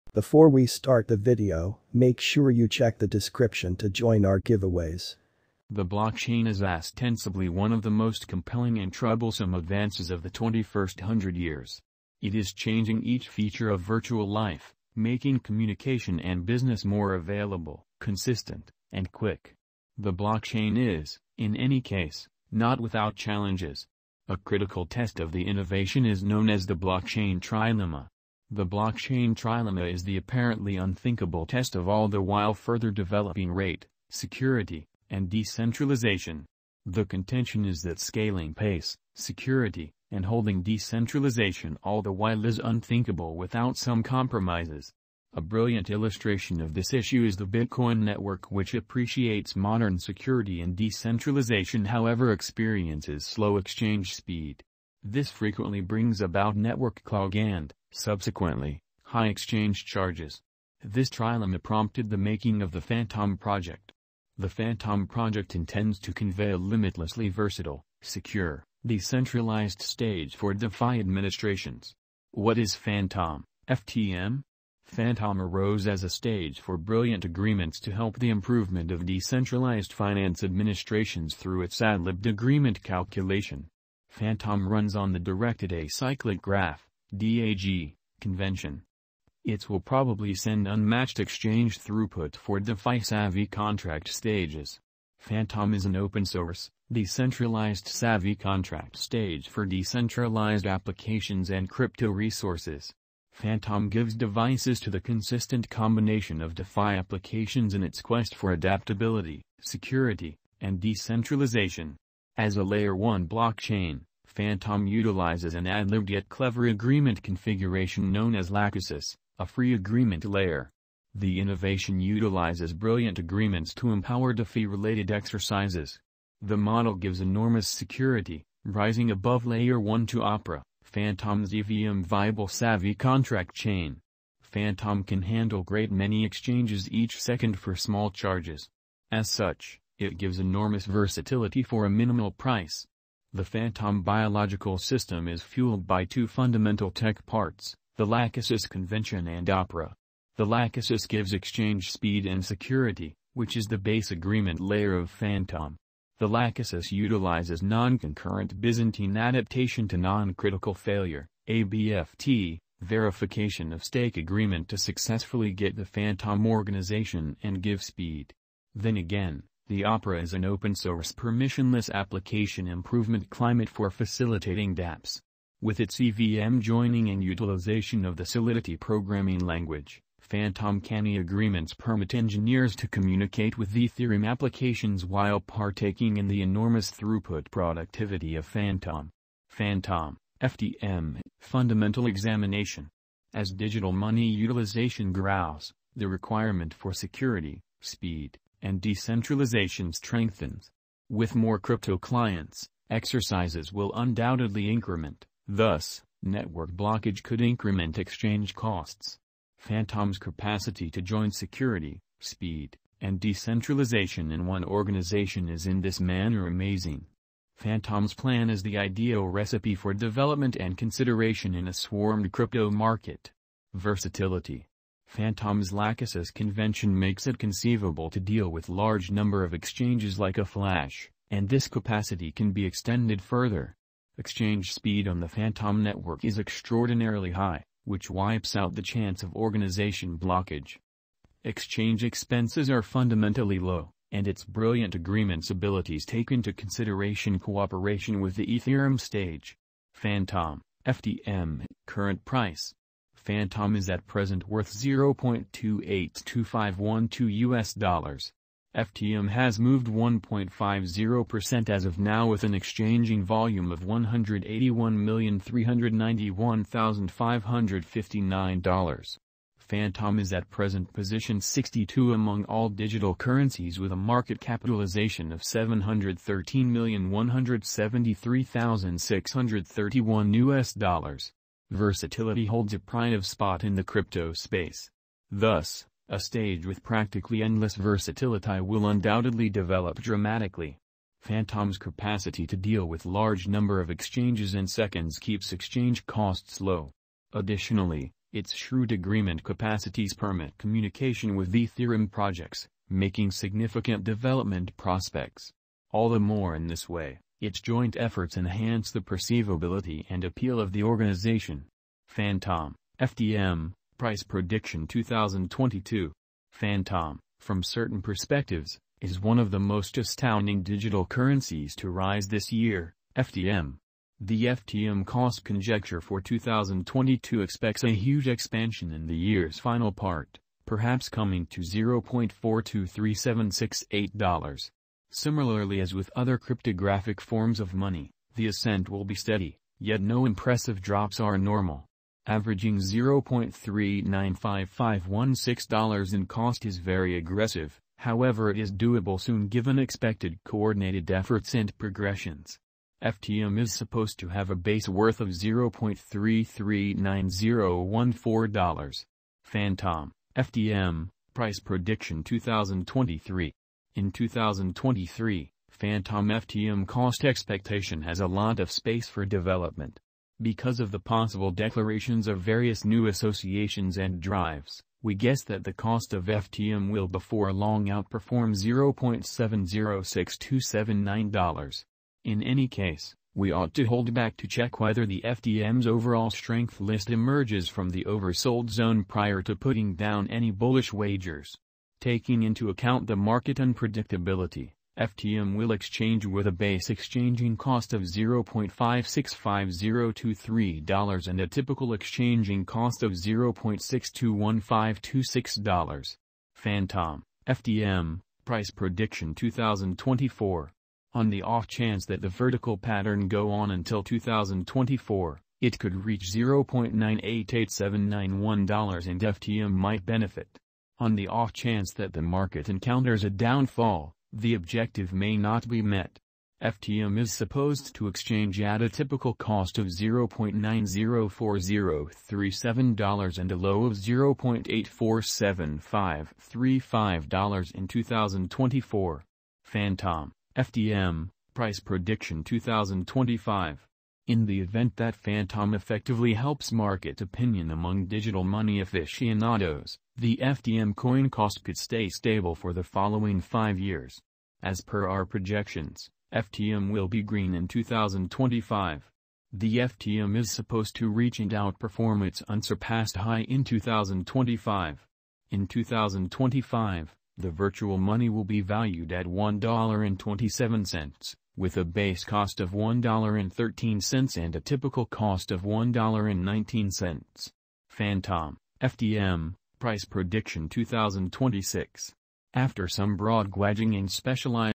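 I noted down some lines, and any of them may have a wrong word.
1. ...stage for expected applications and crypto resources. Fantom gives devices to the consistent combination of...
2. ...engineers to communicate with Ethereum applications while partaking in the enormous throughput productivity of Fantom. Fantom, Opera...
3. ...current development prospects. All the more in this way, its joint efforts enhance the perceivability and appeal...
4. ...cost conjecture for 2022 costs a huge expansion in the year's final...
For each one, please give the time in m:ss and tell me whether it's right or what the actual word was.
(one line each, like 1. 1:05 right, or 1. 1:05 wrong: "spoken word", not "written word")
1. 1:38 wrong: "decentralized", not "expected"
2. 3:02 wrong: "FTM", not "Opera"
3. 5:03 wrong: "significant", not "current"
4. 5:25 wrong: "expects", not "costs".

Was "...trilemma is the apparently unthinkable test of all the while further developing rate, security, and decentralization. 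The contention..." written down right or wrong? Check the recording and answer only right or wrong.
right.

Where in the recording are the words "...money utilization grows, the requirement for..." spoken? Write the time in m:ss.
3:13.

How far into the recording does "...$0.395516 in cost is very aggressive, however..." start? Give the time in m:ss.
5:42.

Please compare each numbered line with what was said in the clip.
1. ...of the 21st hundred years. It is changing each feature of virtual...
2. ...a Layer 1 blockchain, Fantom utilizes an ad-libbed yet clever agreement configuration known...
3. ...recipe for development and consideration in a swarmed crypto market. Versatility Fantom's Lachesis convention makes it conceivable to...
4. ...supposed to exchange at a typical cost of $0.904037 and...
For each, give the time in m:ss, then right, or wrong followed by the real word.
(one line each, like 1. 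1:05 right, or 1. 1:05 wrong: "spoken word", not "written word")
1. 0:10 right
2. 1:52 right
3. 3:39 right
4. 7:07 right.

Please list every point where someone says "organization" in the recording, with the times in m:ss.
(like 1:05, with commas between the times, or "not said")
2:46, 3:34, 3:59, 5:10.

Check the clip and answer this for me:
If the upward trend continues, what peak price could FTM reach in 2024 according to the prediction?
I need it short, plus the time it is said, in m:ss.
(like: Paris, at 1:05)
$0.988791, at 6:56.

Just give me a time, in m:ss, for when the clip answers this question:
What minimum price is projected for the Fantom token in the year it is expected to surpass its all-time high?
7:52.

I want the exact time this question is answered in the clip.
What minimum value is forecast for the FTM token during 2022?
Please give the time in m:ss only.
5:55.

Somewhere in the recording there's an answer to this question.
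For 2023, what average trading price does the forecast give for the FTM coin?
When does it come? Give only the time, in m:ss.
6:43.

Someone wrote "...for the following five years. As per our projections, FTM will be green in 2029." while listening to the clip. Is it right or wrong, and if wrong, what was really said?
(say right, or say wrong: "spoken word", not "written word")
wrong: "2025", not "2029".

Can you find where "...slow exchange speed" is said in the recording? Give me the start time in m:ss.
0:53.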